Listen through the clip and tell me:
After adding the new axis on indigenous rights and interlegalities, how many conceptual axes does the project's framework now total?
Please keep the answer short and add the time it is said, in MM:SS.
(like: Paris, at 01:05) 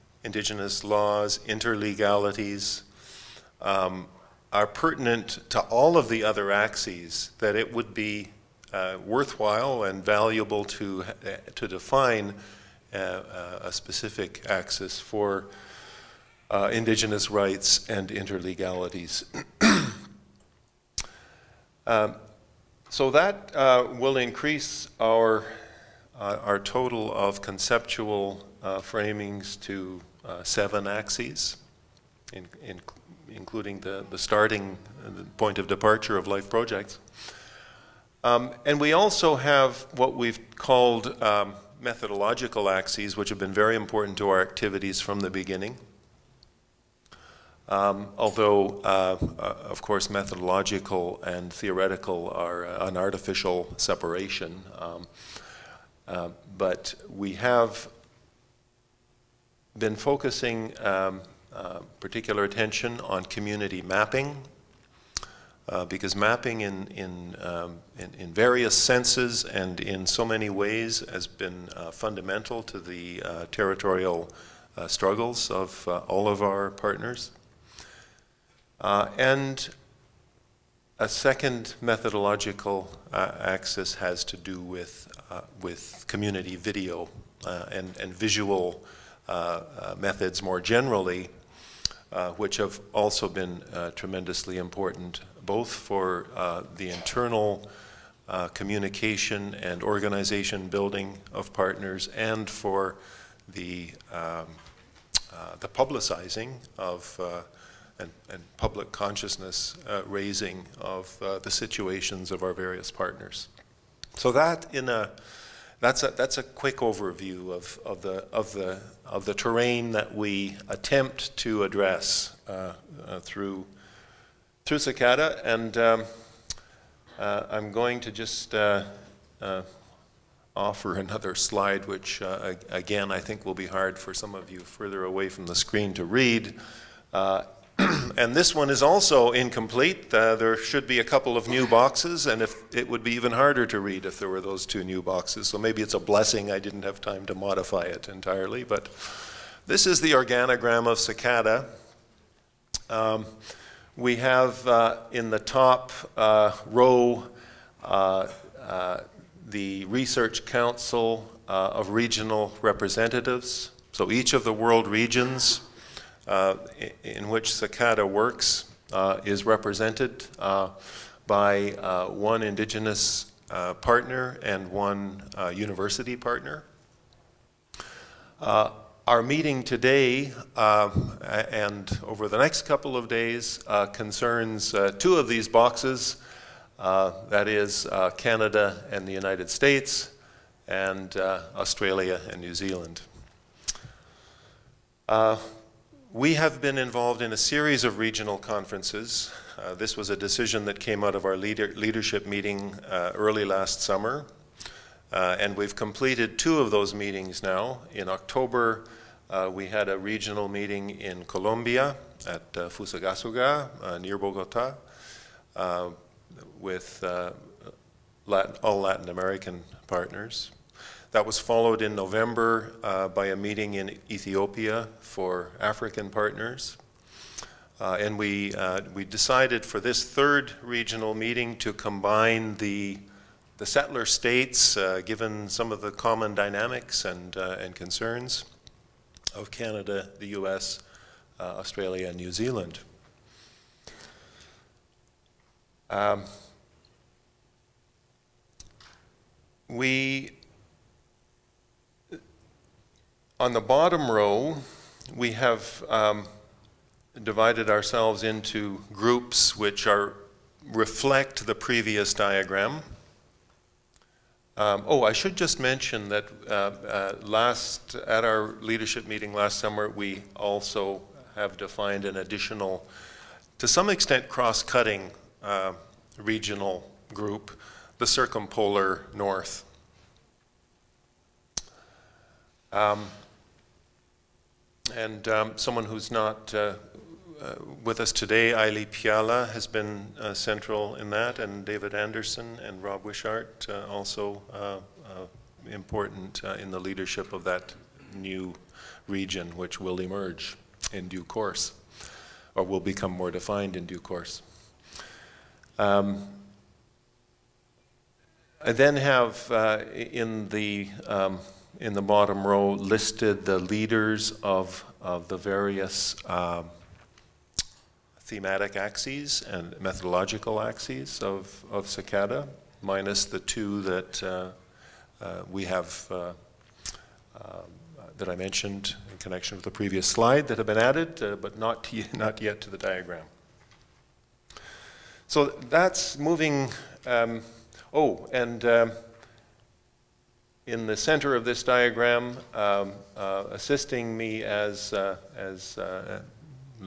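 7, at 00:30.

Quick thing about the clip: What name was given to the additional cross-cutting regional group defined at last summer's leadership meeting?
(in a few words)
circumpolar north.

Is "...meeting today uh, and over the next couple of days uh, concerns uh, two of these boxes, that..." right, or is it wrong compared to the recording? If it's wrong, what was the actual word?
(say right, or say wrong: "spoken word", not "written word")
right.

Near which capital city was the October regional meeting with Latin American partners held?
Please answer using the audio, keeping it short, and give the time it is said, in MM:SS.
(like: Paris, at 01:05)
Bogota, at 03:34.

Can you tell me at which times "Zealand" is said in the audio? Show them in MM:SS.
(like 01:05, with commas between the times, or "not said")
03:12, 04:02.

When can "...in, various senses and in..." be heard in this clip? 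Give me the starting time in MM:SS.
01:08.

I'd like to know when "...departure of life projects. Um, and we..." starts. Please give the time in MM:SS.
00:35.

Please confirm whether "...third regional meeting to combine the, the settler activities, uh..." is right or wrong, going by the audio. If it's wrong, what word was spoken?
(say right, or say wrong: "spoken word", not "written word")
wrong: "states", not "activities".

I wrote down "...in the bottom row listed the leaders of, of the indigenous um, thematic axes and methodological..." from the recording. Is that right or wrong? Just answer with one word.
wrong.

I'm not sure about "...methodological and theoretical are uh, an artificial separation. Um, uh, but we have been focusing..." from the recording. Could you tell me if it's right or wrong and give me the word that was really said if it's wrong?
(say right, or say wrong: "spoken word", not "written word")
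right.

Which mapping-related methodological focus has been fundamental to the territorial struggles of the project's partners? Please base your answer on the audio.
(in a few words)
community mapping.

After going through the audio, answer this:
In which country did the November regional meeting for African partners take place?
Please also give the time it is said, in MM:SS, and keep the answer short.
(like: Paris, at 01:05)
Ethiopia, at 03:44.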